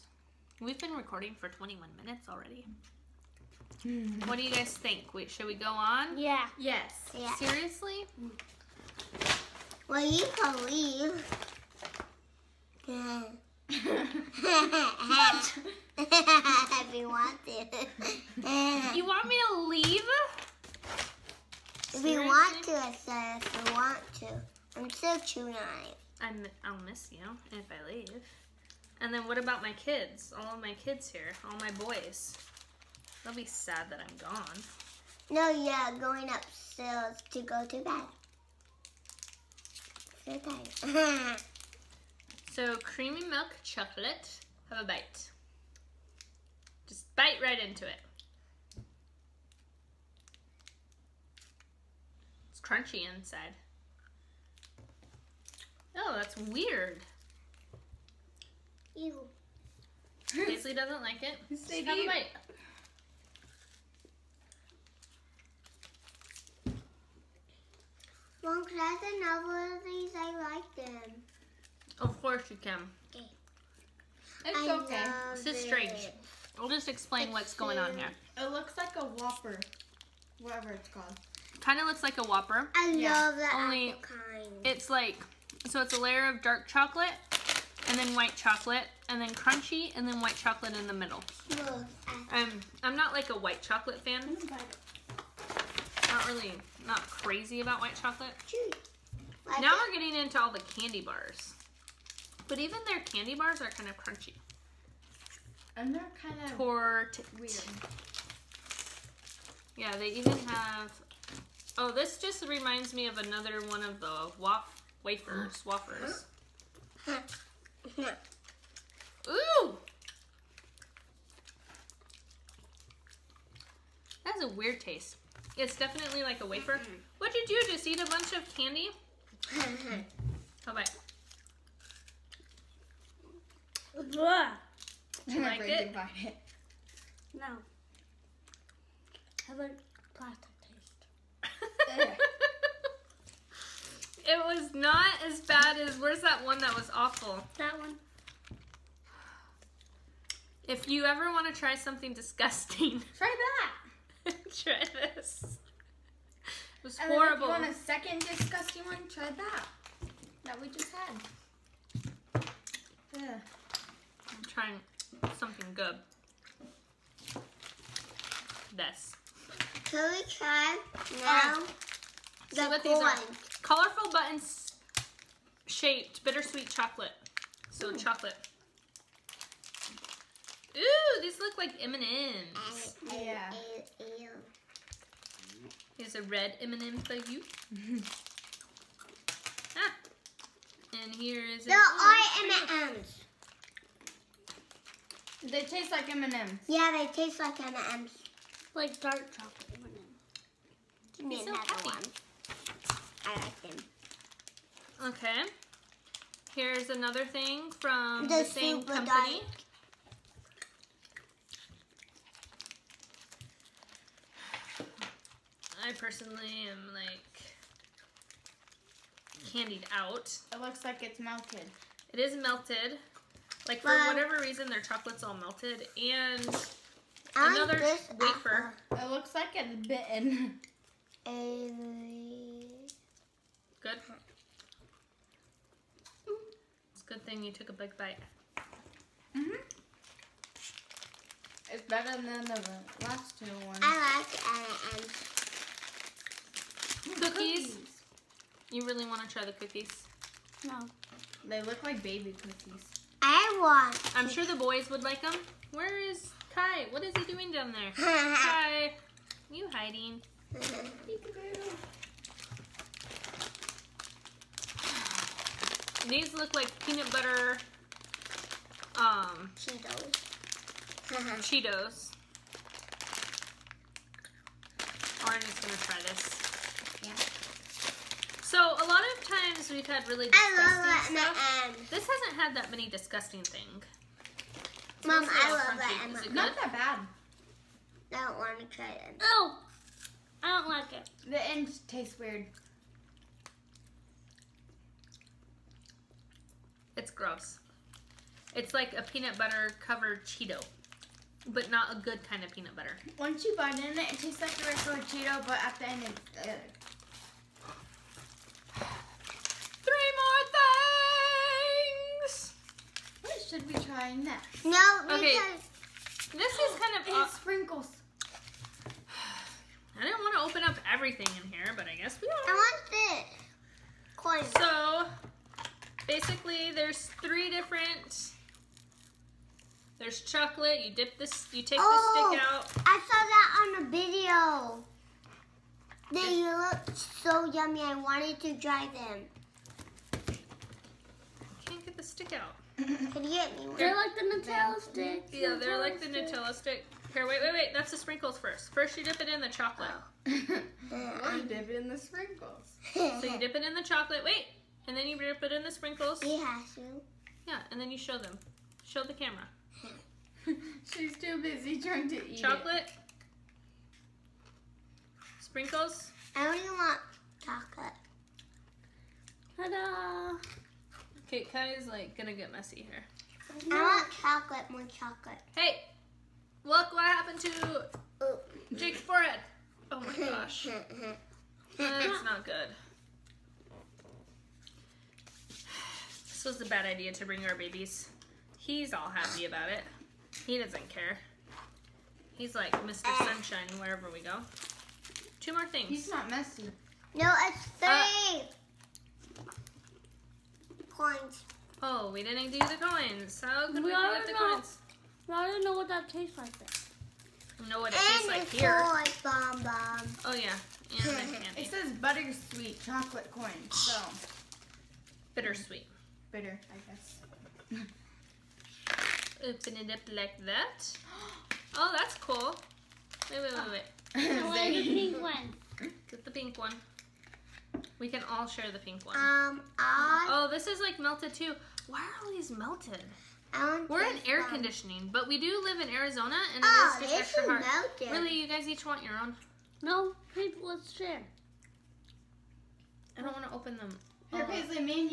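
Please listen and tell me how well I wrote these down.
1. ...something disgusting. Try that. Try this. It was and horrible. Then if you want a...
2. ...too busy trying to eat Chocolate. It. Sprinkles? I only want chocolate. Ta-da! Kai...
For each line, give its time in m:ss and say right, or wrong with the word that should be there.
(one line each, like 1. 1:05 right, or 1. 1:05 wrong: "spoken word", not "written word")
1. 2:31 right
2. 6:01 right.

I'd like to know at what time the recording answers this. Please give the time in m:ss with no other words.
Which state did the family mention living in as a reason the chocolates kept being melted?
7:15.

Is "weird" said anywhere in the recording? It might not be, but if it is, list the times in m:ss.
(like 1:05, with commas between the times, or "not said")
0:56, 1:47, 2:04, 4:52.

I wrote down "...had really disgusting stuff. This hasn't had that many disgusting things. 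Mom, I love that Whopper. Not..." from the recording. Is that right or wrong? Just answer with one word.
wrong.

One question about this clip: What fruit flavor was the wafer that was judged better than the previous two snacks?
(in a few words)
Apple.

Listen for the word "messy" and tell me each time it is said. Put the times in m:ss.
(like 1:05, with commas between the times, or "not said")
6:12, 6:36.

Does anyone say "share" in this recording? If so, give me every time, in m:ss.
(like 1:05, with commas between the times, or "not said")
7:08, 7:20.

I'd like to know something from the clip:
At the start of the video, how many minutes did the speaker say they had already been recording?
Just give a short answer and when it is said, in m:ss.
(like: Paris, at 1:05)
21, at 0:01.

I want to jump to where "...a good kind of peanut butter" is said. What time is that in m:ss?
5:01.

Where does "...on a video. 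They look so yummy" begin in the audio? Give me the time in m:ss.
5:33.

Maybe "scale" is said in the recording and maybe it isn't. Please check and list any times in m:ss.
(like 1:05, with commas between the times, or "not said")
not said.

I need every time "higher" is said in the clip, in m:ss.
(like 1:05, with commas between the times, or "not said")
not said.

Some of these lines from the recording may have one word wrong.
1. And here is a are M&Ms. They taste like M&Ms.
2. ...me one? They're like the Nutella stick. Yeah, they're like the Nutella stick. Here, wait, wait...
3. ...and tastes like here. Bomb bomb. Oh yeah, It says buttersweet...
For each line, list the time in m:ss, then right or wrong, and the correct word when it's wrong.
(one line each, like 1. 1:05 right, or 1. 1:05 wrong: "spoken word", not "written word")
1. 3:11 right
2. 5:43 right
3. 6:47 right.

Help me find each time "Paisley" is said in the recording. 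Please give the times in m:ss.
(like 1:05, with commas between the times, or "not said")
1:00, 7:24.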